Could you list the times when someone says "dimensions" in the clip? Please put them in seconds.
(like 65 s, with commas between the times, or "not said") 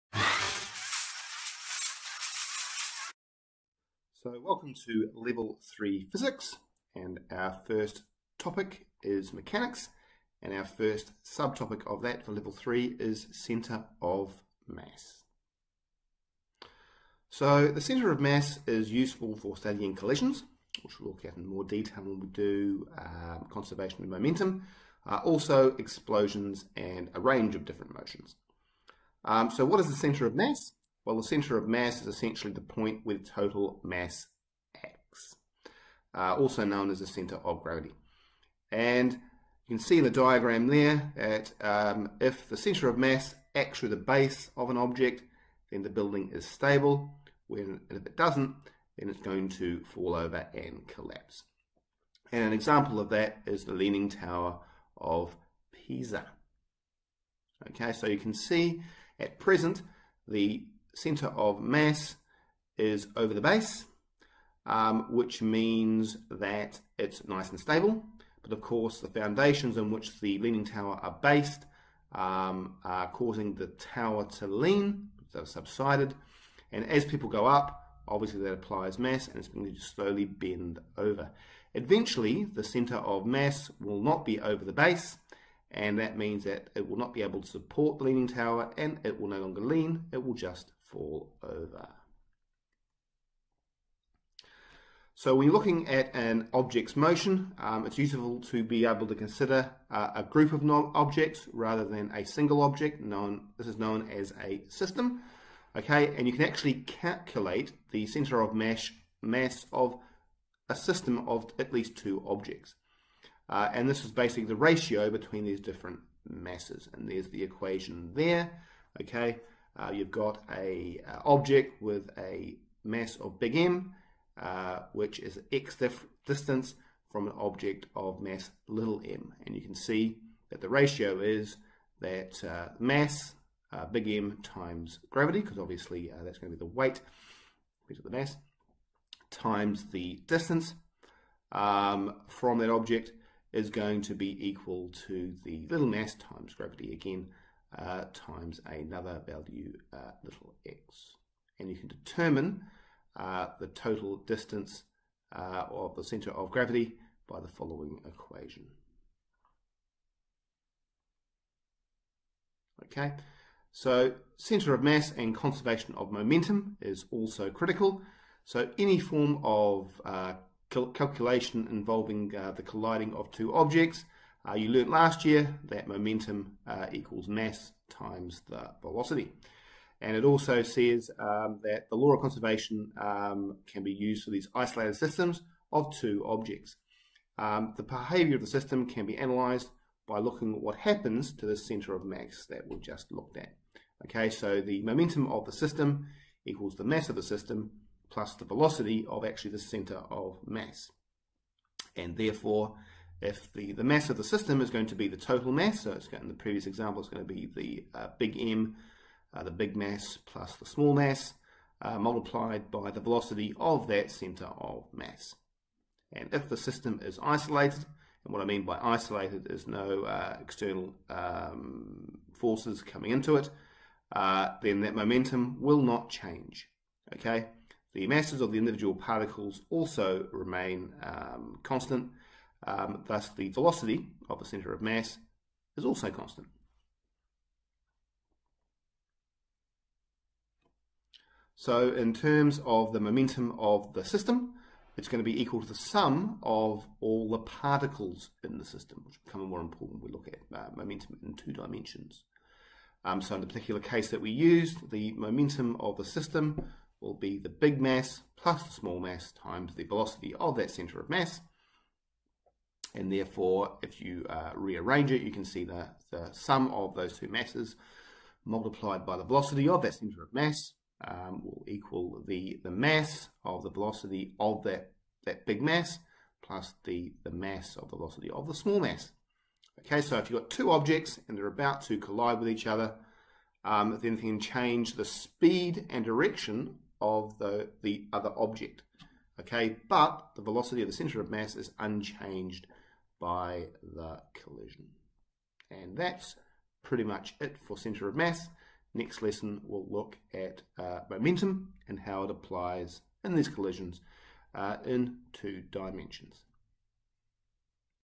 251 s, 305 s.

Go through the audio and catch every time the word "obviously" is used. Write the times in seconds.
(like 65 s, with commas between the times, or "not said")
78 s, 135 s.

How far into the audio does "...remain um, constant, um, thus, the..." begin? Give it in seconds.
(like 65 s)
230 s.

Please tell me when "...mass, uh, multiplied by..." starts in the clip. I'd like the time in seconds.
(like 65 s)
210 s.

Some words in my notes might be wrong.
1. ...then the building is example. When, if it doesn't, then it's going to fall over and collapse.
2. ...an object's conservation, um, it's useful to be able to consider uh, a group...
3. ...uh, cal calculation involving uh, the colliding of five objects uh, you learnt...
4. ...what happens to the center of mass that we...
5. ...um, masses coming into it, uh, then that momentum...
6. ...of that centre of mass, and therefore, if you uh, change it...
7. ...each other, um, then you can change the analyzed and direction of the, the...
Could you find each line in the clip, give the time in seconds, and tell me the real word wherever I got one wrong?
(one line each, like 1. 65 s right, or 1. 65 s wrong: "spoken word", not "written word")
1. 45 s wrong: "stable", not "example"
2. 96 s wrong: "motion", not "conservation"
3. 170 s wrong: "two", not "five"
4. 190 s right
5. 221 s wrong: "forces", not "masses"
6. 260 s wrong: "rearrange", not "change"
7. 282 s wrong: "speed", not "analyzed".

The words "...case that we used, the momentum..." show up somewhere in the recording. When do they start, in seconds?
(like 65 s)
253 s.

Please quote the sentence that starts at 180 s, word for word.
And it also says um, that the law of conservation um, can be used for these isolated systems of two objects.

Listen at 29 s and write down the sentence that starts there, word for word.
Um, so what is the centre of mass?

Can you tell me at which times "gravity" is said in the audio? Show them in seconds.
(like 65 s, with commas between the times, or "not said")
37 s, 135 s, 146 s, 156 s.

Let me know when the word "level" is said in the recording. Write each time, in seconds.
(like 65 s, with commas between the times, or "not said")
5 s, 12 s.